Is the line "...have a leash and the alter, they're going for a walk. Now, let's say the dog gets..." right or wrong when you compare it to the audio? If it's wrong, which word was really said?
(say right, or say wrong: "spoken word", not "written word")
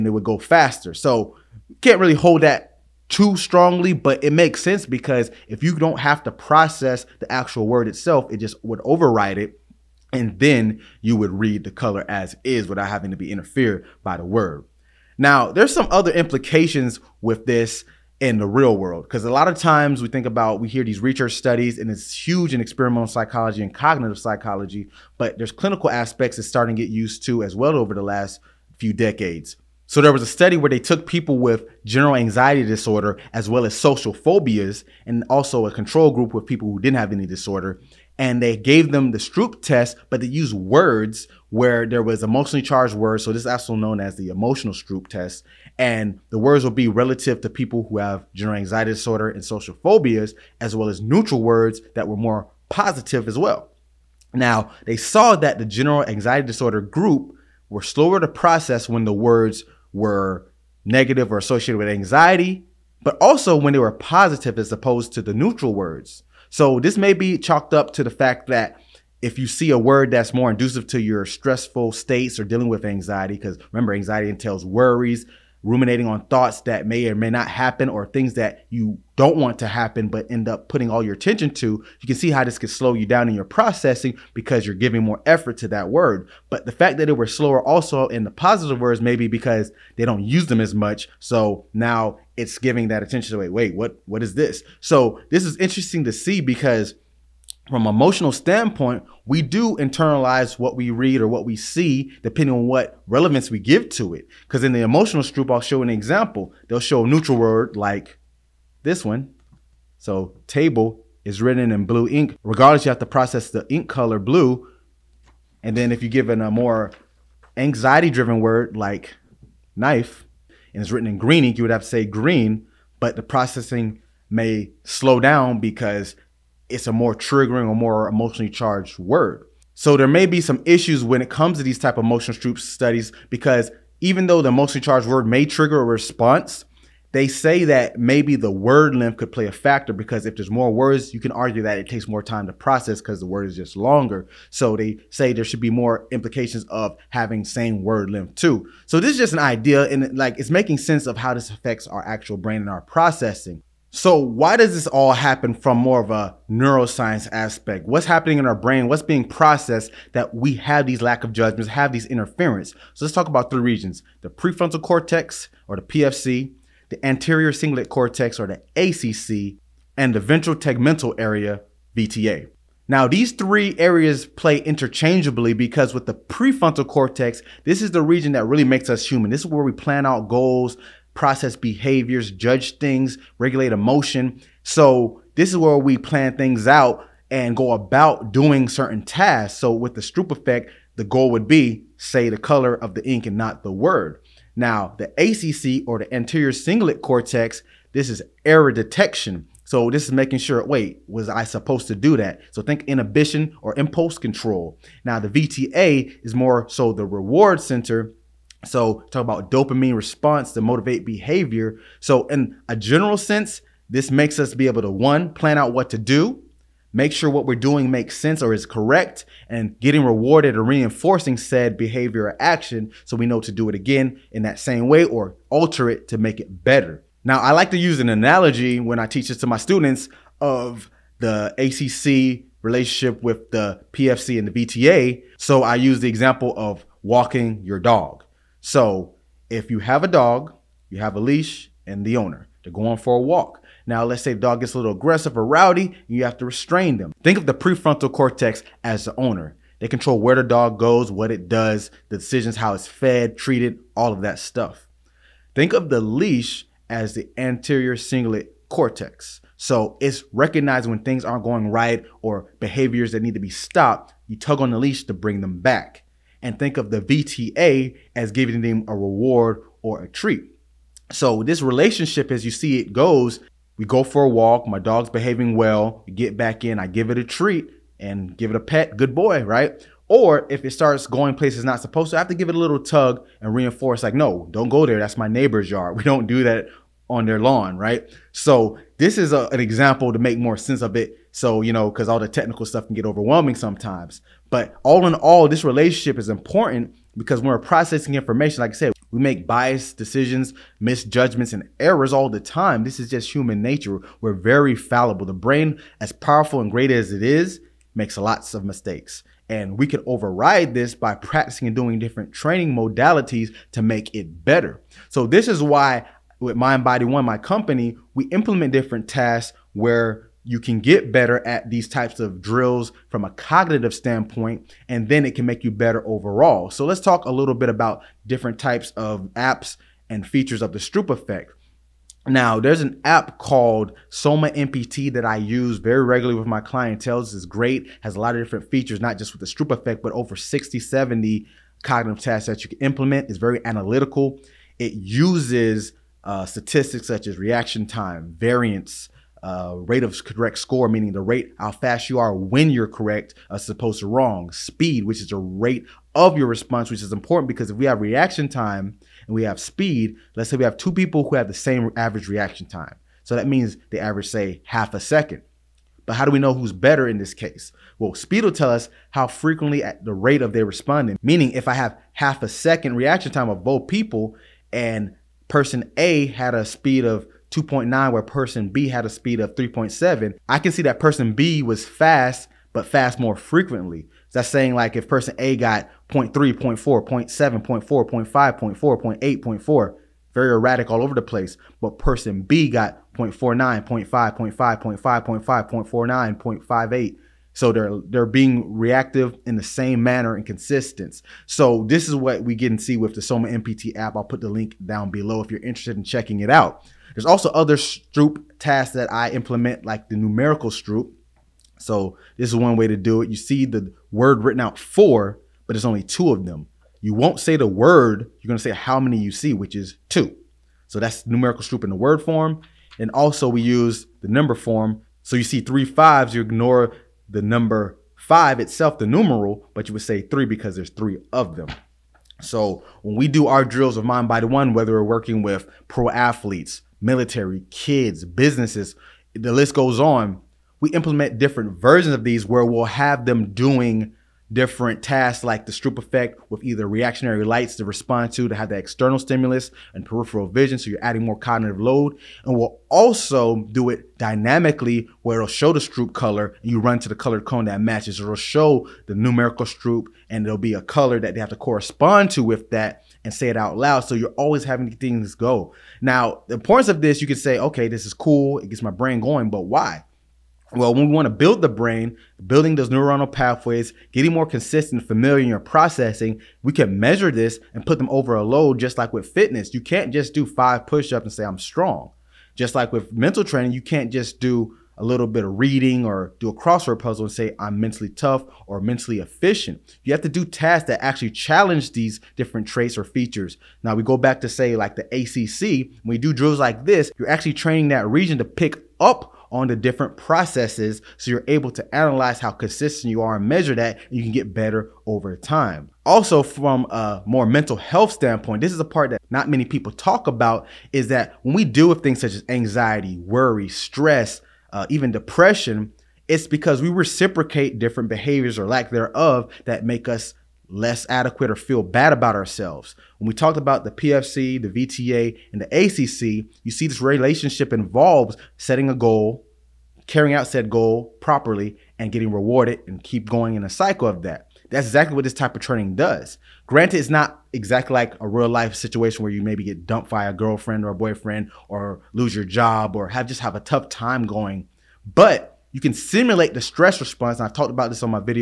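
wrong: "owner", not "alter".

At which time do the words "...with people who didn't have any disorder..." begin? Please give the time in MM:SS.
00:36.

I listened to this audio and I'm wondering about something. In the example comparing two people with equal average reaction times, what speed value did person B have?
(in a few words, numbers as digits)
3.7.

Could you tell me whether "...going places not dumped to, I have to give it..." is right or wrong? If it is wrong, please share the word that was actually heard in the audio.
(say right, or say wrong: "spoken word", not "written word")
wrong: "supposed", not "dumped".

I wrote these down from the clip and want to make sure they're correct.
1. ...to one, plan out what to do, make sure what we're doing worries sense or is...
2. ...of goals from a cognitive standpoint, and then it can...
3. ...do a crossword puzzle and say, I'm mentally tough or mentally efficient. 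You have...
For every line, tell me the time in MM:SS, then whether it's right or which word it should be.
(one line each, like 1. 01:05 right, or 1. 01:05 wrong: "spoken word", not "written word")
1. 03:34 wrong: "makes", not "worries"
2. 05:22 wrong: "drills", not "goals"
3. 08:06 right.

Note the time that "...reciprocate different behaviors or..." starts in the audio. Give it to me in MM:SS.
08:36.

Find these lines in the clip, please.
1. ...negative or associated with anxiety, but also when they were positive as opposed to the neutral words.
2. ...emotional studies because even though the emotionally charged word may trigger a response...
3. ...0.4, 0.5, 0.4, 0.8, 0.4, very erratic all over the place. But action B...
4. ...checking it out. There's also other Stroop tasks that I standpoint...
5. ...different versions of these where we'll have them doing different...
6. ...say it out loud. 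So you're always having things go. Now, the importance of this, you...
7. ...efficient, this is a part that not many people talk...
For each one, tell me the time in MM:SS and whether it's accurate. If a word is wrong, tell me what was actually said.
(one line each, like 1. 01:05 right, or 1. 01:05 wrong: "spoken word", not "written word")
1. 01:00 right
2. 02:12 right
3. 06:27 wrong: "person", not "action"
4. 06:46 wrong: "implement", not "standpoint"
5. 07:21 right
6. 07:43 right
7. 08:28 wrong: "standpoint", not "efficient".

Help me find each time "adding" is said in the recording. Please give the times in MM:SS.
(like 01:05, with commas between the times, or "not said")
07:31.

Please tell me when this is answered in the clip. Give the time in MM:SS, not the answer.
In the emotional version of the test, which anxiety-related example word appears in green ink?
01:59.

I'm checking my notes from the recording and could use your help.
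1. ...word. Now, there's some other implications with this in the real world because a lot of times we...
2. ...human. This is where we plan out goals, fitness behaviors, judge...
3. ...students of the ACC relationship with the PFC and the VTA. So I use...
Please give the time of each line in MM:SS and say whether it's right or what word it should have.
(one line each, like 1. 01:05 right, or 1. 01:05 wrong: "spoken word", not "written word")
1. 00:14 right
2. 02:59 wrong: "process", not "fitness"
3. 03:49 right.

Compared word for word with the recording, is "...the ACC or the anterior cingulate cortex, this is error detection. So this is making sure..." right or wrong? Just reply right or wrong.
right.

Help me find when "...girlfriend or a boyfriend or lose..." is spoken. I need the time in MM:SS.
09:00.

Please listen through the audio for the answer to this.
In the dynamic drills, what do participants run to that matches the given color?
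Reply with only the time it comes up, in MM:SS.
07:37.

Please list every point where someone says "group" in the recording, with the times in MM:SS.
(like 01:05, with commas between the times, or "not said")
00:36, 00:56.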